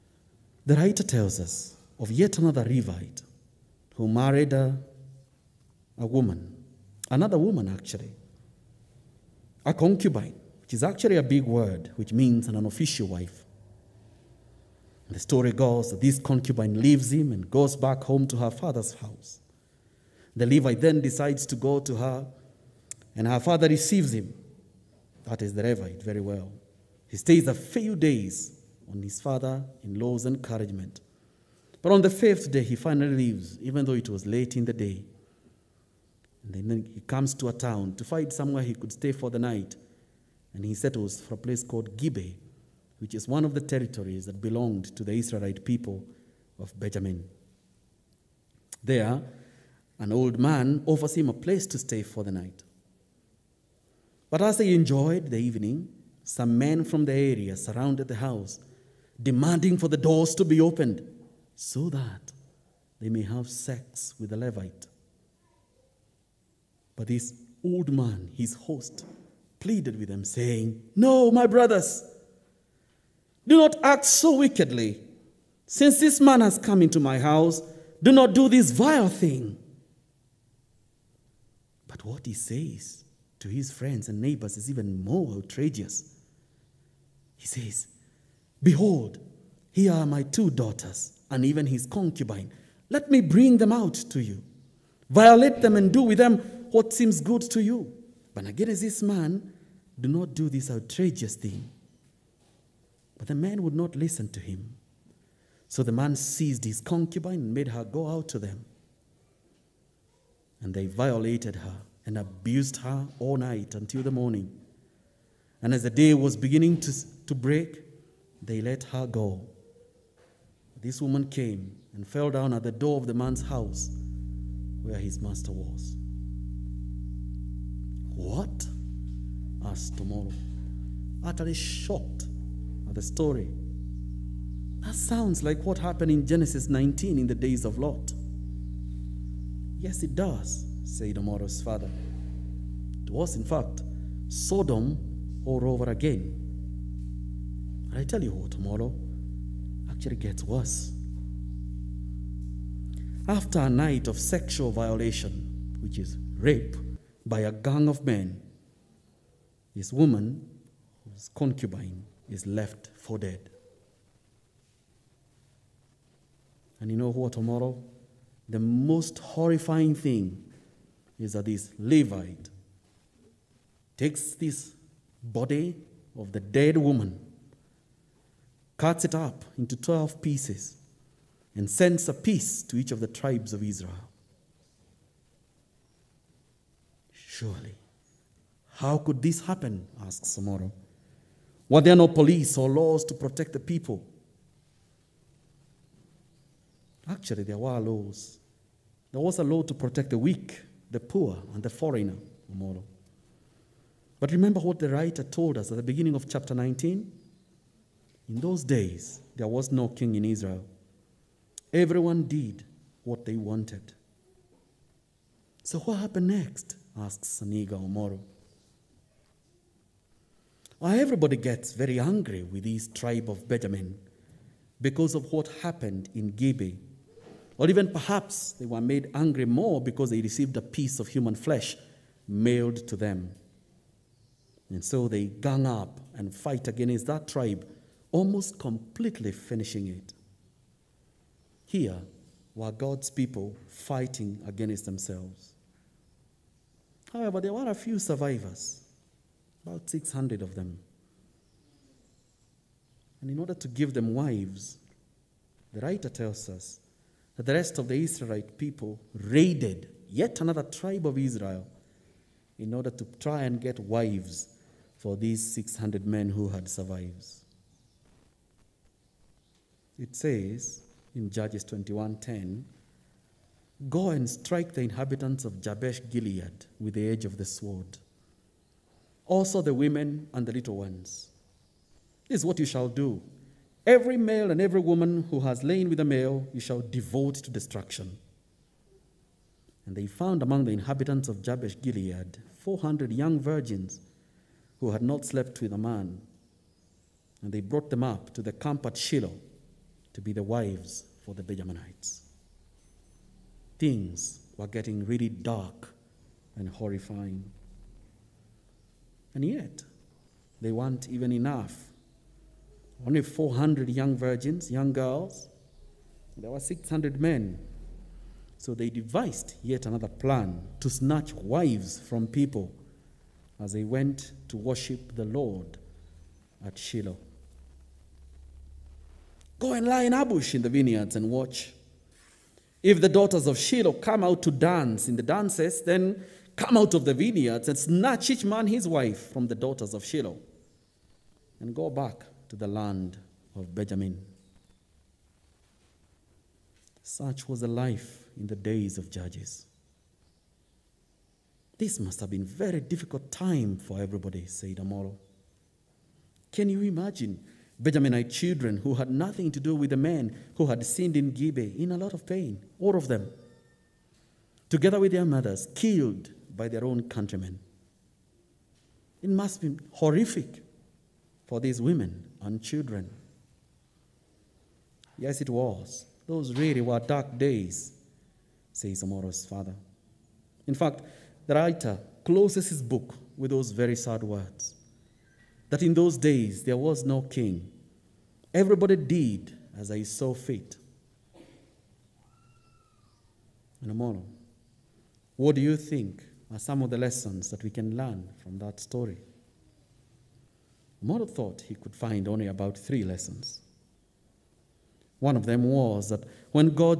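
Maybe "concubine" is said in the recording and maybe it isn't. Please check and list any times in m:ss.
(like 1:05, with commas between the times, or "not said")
0:09, 0:16, 1:31, 1:46, 2:41.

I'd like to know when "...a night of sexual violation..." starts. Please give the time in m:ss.
2:33.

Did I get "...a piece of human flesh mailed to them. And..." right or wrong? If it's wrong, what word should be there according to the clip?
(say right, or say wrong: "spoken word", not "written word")
right.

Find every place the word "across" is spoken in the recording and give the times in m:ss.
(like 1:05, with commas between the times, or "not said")
not said.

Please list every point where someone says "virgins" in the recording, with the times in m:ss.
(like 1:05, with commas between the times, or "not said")
4:53, 5:14.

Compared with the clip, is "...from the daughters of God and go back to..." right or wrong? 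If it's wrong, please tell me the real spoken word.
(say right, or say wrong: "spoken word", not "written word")
wrong: "Shiloh", not "God".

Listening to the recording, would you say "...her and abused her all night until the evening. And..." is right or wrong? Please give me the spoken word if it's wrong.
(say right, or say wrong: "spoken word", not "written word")
wrong: "morning", not "evening".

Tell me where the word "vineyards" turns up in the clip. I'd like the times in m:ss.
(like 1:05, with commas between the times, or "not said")
5:30, 5:37.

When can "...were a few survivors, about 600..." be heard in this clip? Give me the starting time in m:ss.
4:07.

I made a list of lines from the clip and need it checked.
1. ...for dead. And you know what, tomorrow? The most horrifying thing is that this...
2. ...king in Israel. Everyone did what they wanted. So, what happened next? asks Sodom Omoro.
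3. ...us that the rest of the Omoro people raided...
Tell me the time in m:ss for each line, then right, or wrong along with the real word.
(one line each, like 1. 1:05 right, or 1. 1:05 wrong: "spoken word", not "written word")
1. 2:42 right
2. 3:29 wrong: "Aniga", not "Sodom"
3. 4:16 wrong: "Israelite", not "Omoro".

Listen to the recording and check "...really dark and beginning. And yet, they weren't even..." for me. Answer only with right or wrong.
wrong.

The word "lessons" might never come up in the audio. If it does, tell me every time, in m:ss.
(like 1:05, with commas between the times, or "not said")
6:36, 6:43.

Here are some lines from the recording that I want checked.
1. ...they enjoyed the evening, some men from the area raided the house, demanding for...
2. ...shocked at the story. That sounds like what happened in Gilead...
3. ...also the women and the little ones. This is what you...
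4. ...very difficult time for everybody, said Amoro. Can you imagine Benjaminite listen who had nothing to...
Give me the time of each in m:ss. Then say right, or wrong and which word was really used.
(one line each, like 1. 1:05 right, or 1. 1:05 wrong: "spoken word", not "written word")
1. 0:54 wrong: "surrounded", not "raided"
2. 2:11 wrong: "Genesis", not "Gilead"
3. 4:39 right
4. 5:52 wrong: "children", not "listen".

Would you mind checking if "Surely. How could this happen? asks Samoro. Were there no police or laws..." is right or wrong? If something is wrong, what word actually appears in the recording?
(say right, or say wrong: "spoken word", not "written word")
right.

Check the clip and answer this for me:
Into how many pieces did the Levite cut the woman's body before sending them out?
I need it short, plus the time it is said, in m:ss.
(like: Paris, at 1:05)
12, at 2:59.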